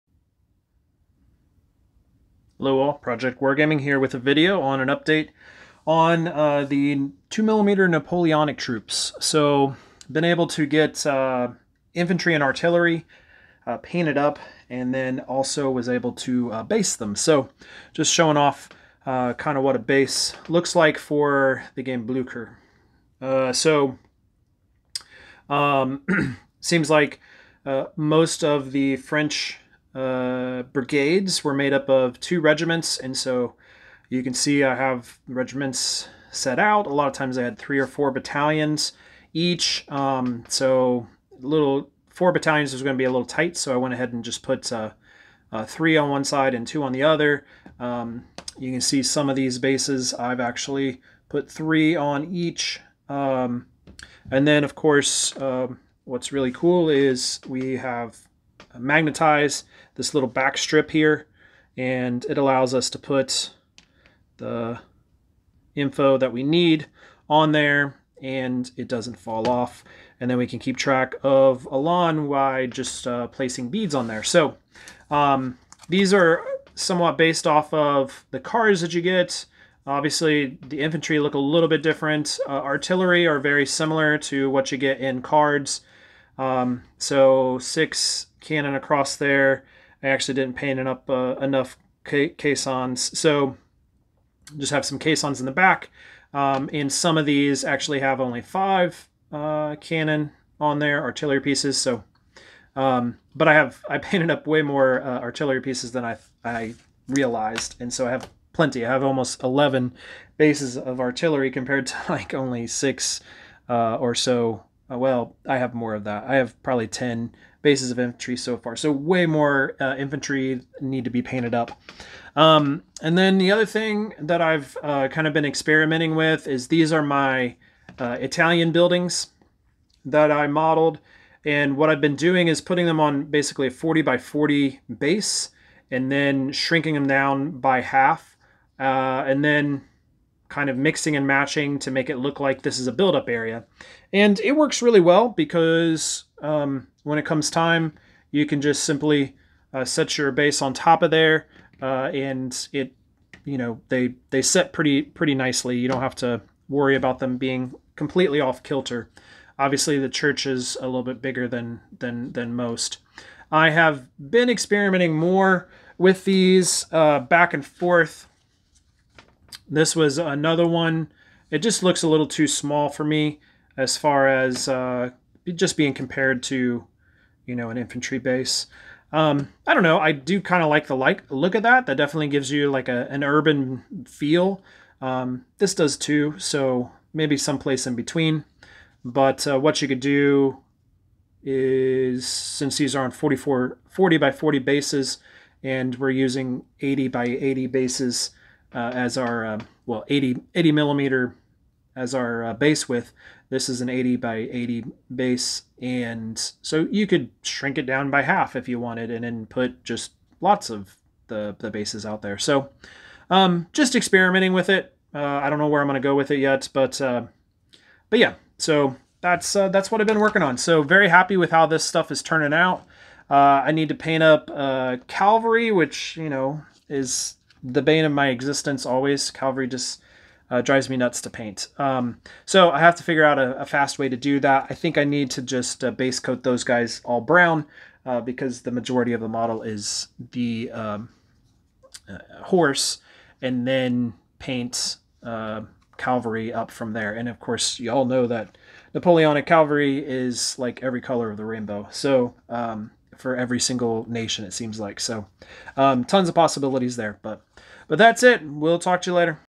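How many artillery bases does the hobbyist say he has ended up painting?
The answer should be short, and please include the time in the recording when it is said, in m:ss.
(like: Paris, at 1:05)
11, at 1:49.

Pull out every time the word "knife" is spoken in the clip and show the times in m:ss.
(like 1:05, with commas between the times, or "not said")
not said.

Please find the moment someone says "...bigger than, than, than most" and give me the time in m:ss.
2:41.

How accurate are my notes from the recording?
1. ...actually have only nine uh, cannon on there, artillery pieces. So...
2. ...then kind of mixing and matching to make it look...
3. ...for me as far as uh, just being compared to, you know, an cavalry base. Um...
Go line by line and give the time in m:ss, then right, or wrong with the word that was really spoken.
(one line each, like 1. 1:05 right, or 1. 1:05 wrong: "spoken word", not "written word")
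1. 1:37 wrong: "five", not "nine"
2. 2:19 right
3. 2:52 wrong: "infantry", not "cavalry".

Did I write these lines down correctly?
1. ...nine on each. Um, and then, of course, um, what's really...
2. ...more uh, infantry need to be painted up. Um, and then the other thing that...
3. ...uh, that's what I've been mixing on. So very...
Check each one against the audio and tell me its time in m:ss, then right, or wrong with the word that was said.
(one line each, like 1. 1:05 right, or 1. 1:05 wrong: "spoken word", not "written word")
1. 0:51 wrong: "three", not "nine"
2. 1:59 right
3. 3:39 wrong: "working", not "mixing".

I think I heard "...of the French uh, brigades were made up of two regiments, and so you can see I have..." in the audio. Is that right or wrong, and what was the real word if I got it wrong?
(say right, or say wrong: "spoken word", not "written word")
right.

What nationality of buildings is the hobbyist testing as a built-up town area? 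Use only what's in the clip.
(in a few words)
Italian.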